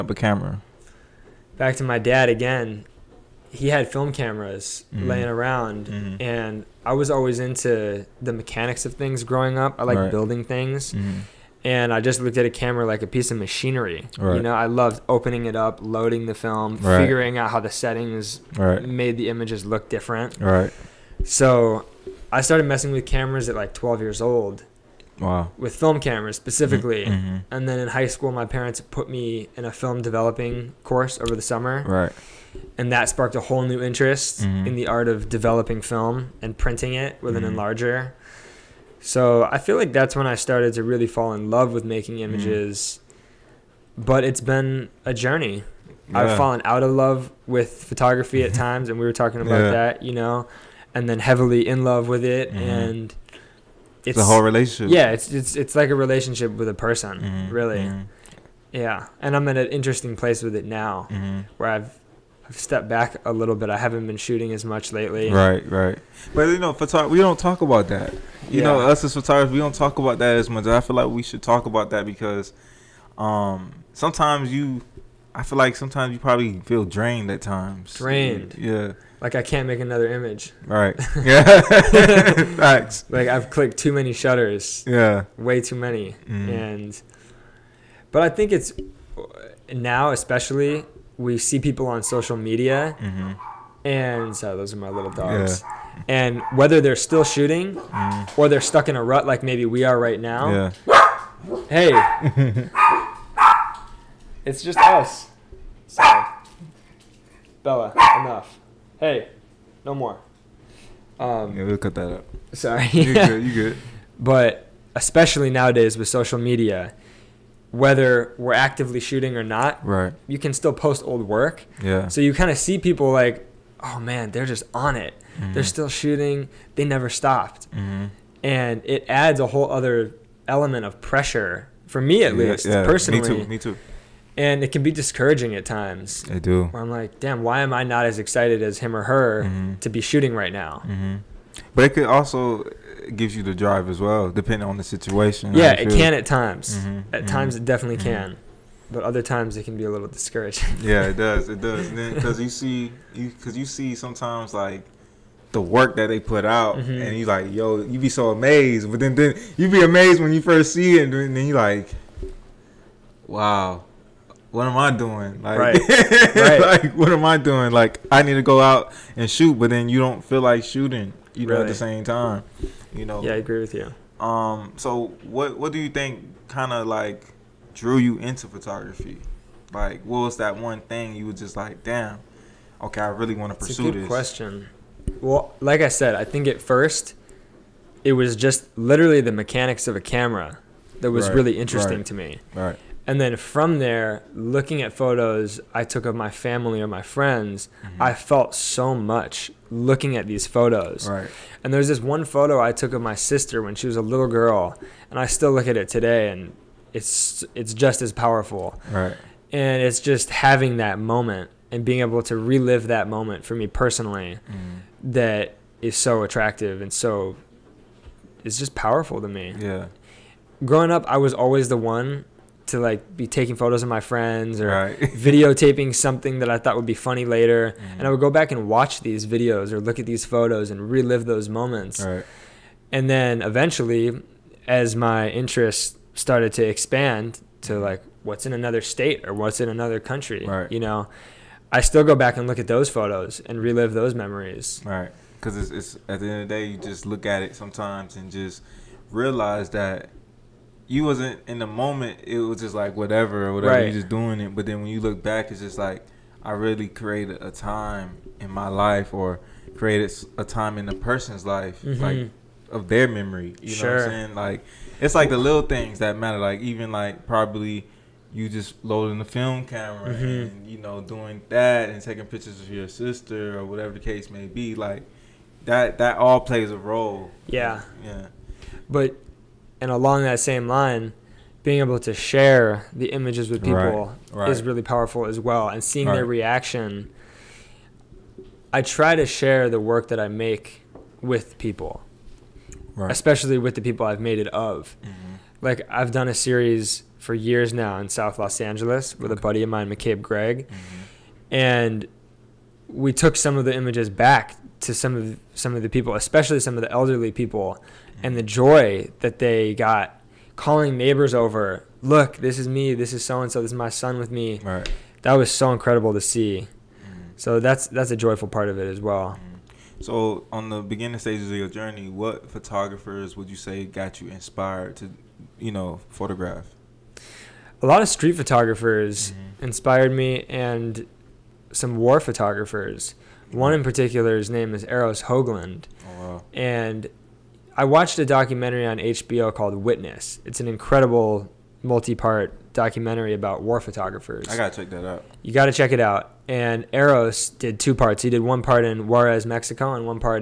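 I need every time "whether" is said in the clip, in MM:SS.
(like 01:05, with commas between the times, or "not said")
01:36, 01:57.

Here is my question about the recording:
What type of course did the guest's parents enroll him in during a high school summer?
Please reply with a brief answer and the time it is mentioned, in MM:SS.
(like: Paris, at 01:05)
Film developing, at 00:29.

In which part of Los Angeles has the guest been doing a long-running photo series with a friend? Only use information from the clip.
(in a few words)
South Los Angeles.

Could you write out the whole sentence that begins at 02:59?
Like, what was that one thing you were just like, damn, okay, I really want to pursue a good this?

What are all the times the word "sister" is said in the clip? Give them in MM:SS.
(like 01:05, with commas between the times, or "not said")
03:23, 04:32.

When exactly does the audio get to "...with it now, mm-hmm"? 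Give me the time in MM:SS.
01:00.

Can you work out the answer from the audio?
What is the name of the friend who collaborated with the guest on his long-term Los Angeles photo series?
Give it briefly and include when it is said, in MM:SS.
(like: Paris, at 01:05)
McCabe Gregg, at 04:59.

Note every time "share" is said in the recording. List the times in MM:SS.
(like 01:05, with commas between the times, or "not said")
04:42, 04:49.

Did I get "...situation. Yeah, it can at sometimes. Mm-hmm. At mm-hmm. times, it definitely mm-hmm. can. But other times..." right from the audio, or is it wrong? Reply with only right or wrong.
wrong.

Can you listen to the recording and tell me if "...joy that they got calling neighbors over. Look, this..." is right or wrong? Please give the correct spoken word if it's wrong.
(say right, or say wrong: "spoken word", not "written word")
right.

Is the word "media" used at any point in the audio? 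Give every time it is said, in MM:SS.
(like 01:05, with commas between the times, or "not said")
01:32, 01:56.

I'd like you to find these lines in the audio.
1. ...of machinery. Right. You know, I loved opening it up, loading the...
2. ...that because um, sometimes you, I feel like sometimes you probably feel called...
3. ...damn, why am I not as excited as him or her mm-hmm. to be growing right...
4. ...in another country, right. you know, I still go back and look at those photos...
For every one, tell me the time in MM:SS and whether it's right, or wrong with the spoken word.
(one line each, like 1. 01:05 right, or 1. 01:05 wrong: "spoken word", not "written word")
1. 00:13 right
2. 01:11 wrong: "drained", not "called"
3. 02:17 wrong: "shooting", not "growing"
4. 03:59 right.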